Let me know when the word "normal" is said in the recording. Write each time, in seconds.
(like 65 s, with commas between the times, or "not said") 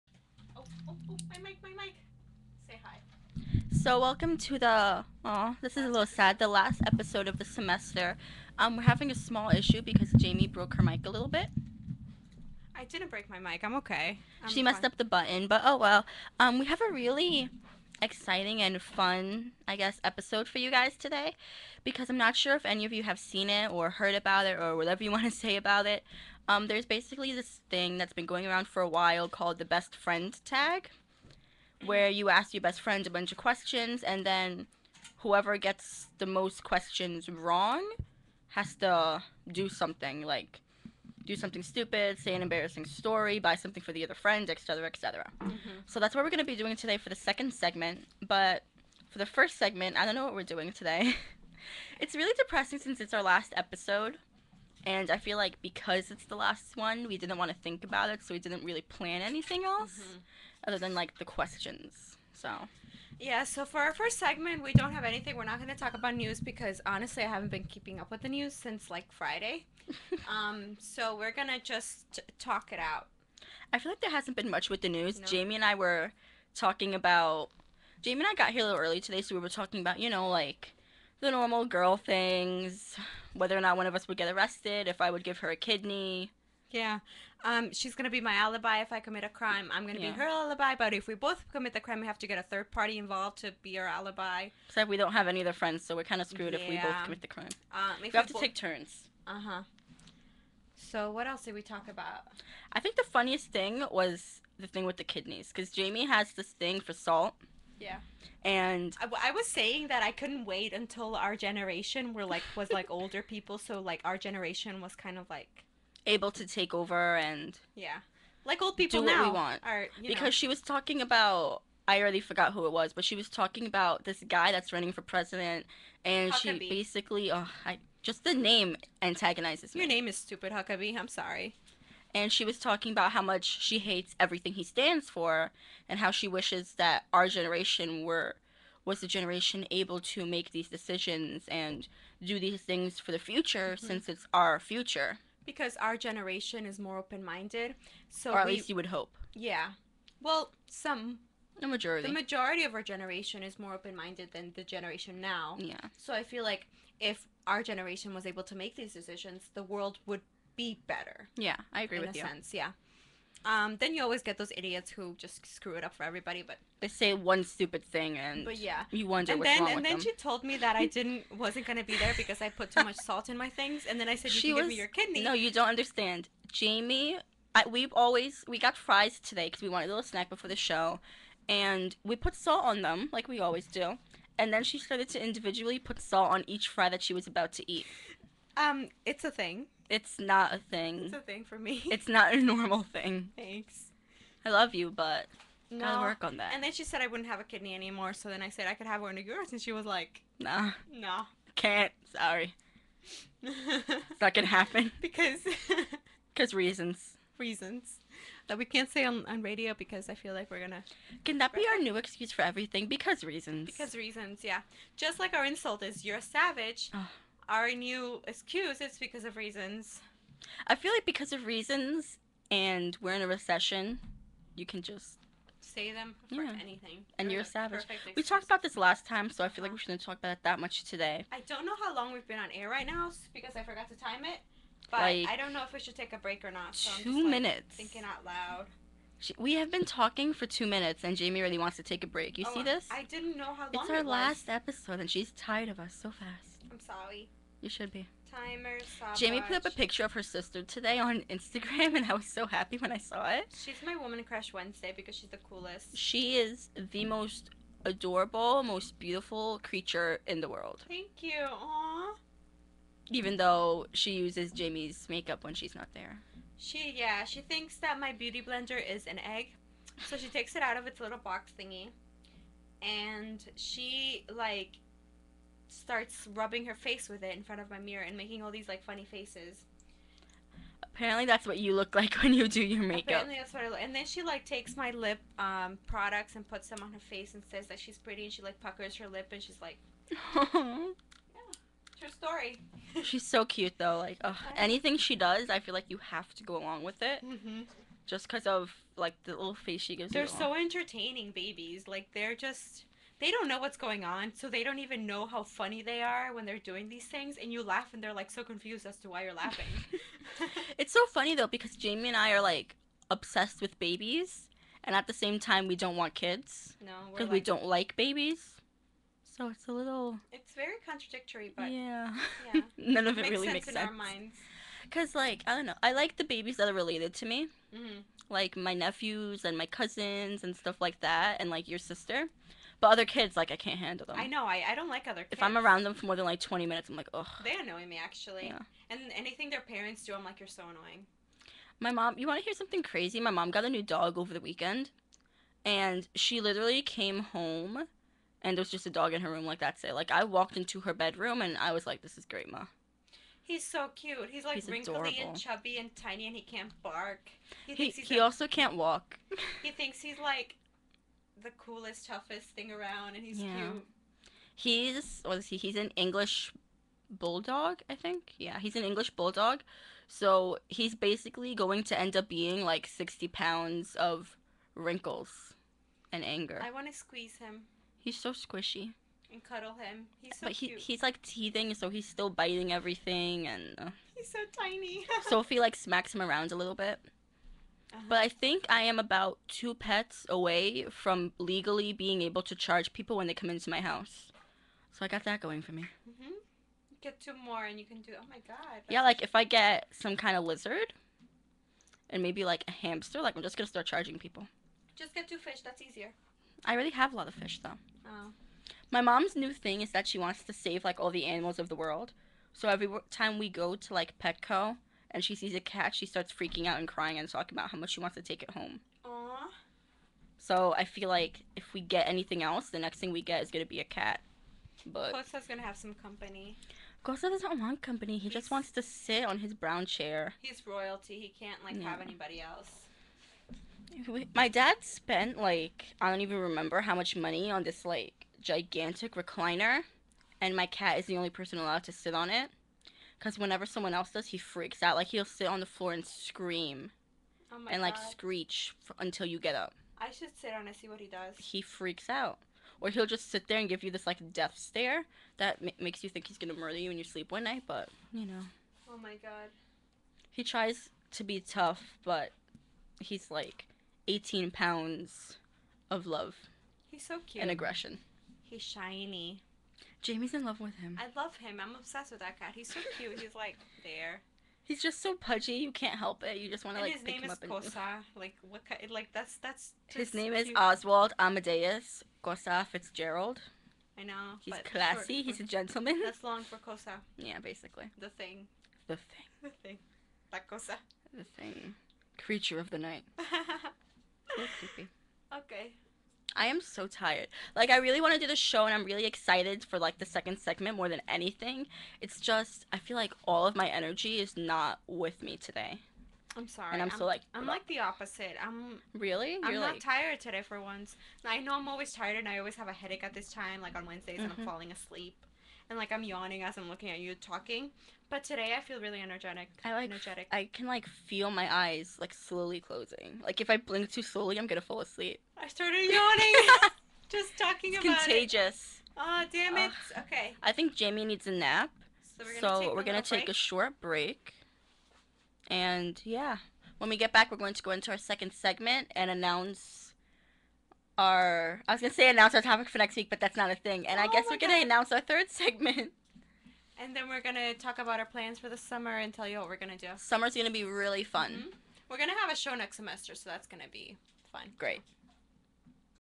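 81 s, 192 s.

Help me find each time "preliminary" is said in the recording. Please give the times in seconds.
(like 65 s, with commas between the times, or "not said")
not said.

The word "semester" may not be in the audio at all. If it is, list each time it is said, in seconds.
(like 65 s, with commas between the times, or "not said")
7 s, 552 s.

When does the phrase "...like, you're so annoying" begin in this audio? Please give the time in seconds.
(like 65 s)
340 s.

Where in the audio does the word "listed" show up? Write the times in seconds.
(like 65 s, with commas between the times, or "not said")
not said.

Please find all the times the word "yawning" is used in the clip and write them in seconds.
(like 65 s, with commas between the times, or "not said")
516 s, 525 s.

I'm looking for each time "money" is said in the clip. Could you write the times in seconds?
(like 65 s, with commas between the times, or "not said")
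437 s.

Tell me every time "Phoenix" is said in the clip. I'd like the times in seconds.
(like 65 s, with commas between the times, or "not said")
not said.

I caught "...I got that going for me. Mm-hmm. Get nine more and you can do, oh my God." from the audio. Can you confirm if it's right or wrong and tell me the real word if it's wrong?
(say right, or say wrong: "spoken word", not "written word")
wrong: "two", not "nine".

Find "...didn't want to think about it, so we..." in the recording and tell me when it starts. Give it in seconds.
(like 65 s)
57 s.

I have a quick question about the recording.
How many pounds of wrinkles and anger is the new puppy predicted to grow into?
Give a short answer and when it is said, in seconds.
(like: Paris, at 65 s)
60, at 372 s.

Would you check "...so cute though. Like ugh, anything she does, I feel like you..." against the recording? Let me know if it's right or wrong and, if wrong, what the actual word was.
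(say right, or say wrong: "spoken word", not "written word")
right.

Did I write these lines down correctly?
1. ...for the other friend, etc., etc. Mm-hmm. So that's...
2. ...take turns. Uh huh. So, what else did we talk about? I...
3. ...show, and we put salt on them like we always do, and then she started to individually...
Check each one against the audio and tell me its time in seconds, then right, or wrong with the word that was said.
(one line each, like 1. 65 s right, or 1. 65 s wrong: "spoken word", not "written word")
1. 43 s right
2. 98 s right
3. 180 s right.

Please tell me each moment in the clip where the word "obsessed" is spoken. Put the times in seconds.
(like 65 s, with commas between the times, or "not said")
313 s, 471 s.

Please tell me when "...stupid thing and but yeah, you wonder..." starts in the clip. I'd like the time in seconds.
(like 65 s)
167 s.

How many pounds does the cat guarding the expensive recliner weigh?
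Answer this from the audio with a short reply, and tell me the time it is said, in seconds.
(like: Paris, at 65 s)
18, at 464 s.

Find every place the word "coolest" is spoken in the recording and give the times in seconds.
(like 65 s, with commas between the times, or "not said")
255 s, 361 s.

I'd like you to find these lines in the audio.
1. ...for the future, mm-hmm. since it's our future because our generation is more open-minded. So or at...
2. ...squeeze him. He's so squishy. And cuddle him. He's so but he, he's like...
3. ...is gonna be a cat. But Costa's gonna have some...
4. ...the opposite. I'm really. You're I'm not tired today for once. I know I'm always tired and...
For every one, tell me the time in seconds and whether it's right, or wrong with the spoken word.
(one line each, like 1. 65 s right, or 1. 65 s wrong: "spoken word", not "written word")
1. 142 s right
2. 376 s right
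3. 423 s right
4. 507 s right.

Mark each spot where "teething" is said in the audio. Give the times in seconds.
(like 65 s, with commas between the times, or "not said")
381 s.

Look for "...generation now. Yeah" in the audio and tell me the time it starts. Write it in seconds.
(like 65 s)
154 s.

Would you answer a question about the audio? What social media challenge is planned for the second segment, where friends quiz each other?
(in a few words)
best friend tag.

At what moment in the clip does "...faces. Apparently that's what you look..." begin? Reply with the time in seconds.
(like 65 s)
279 s.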